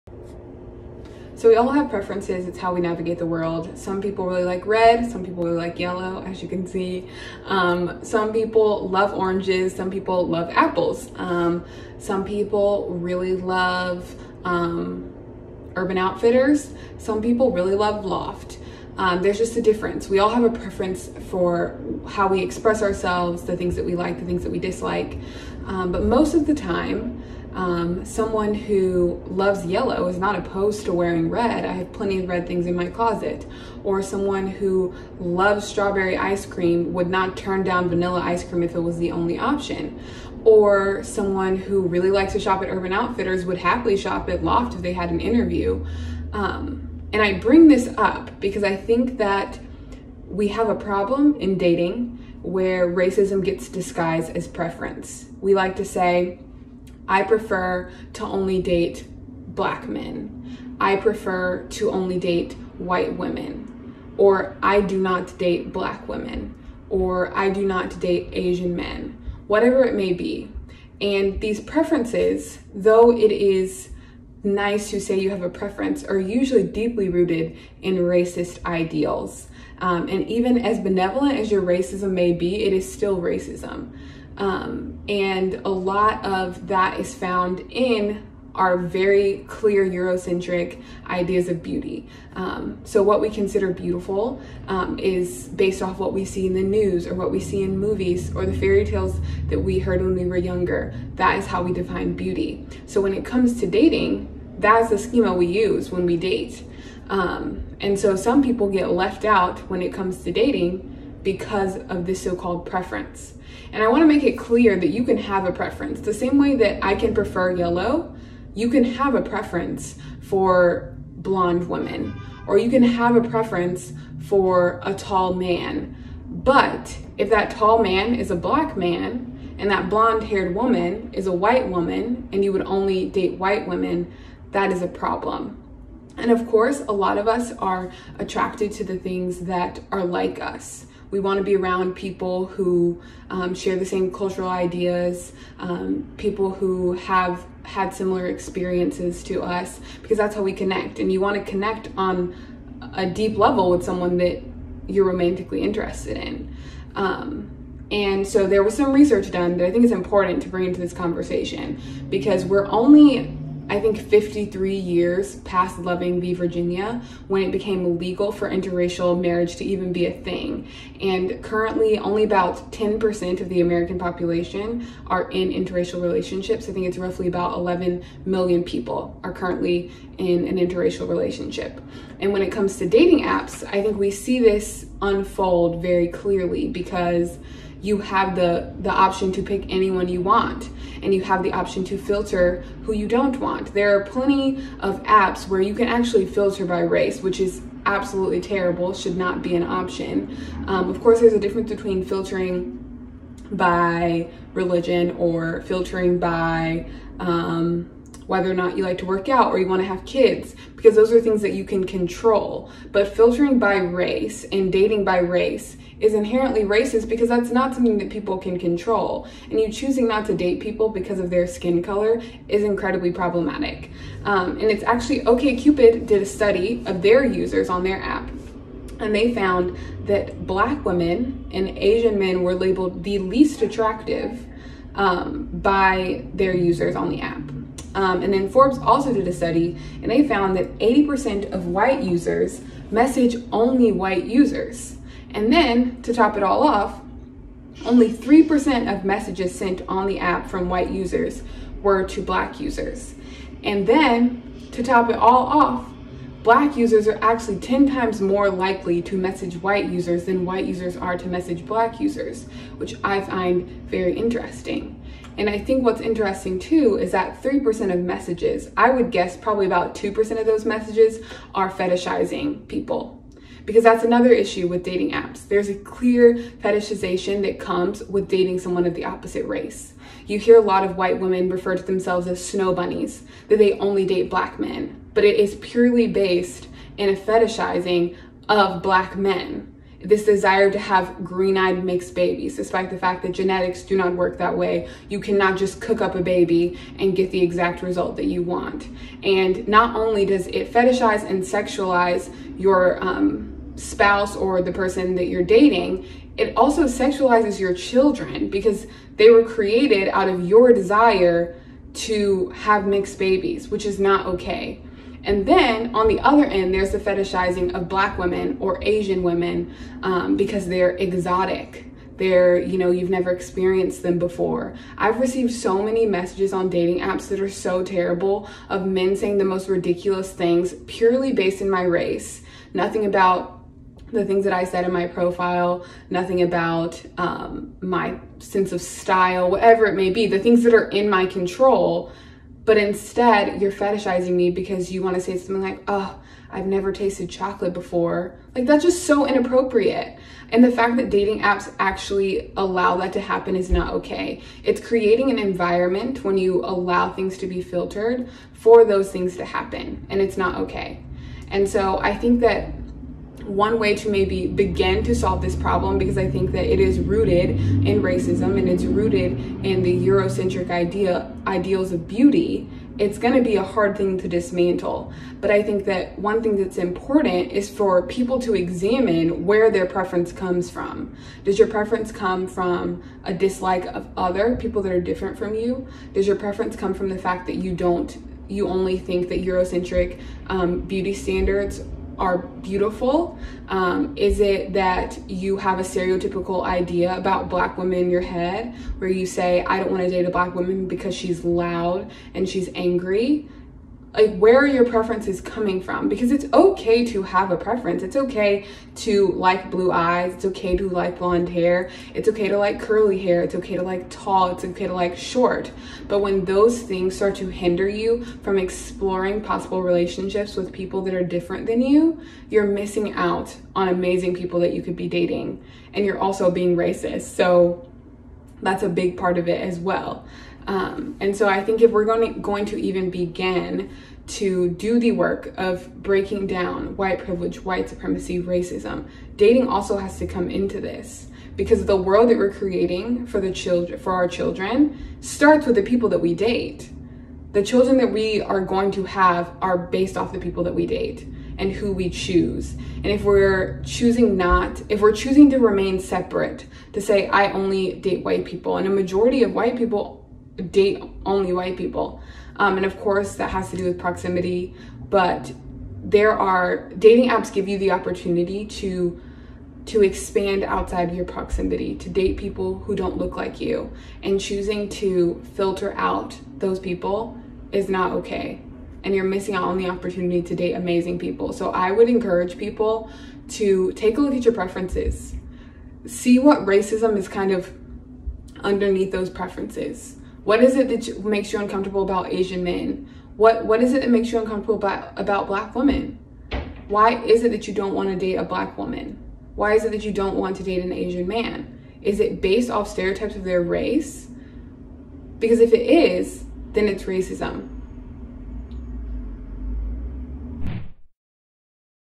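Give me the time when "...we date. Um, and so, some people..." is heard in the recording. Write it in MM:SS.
01:46.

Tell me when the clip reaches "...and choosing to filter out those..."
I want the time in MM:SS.
07:54.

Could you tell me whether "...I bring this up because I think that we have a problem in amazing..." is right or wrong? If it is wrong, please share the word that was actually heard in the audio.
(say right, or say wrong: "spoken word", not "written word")
wrong: "dating", not "amazing".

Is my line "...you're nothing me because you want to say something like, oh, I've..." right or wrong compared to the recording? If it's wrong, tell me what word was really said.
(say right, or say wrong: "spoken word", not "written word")
wrong: "fetishizing", not "nothing".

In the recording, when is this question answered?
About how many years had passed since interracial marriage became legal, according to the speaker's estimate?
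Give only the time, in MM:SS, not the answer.
02:43.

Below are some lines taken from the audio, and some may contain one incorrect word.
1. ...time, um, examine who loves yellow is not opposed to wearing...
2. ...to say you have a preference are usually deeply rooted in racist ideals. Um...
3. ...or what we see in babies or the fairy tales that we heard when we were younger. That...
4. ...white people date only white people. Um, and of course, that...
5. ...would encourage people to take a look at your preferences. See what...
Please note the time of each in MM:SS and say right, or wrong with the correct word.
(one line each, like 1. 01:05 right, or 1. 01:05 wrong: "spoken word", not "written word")
1. 00:26 wrong: "someone", not "examine"
2. 01:14 right
3. 01:37 wrong: "movies", not "babies"
4. 07:39 right
5. 08:01 right.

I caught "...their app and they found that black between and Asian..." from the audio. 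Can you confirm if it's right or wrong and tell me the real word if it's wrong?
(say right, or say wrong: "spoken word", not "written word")
wrong: "women", not "between".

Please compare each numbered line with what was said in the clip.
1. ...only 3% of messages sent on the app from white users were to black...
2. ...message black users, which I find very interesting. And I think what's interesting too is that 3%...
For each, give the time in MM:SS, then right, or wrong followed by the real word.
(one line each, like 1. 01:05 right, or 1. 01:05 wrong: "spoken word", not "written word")
1. 04:07 right
2. 04:21 right.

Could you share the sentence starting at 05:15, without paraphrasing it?
And then on the other end, there's the fetishizing of black women or Asian women um, because they're exotic.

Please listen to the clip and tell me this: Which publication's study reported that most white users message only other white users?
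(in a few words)
Forbes.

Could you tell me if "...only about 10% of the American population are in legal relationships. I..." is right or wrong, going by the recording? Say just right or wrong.
wrong.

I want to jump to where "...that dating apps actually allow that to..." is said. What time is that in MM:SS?
05:50.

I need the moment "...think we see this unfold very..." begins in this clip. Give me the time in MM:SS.
03:03.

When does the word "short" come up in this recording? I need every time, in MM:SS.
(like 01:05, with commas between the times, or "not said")
06:55.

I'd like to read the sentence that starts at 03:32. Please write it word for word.
But filtering by race and dating by race is inherently racist because that's not something that people can control.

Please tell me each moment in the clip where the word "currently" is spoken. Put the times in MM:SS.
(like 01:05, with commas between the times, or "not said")
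02:51, 02:59.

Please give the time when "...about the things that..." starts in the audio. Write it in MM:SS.
05:33.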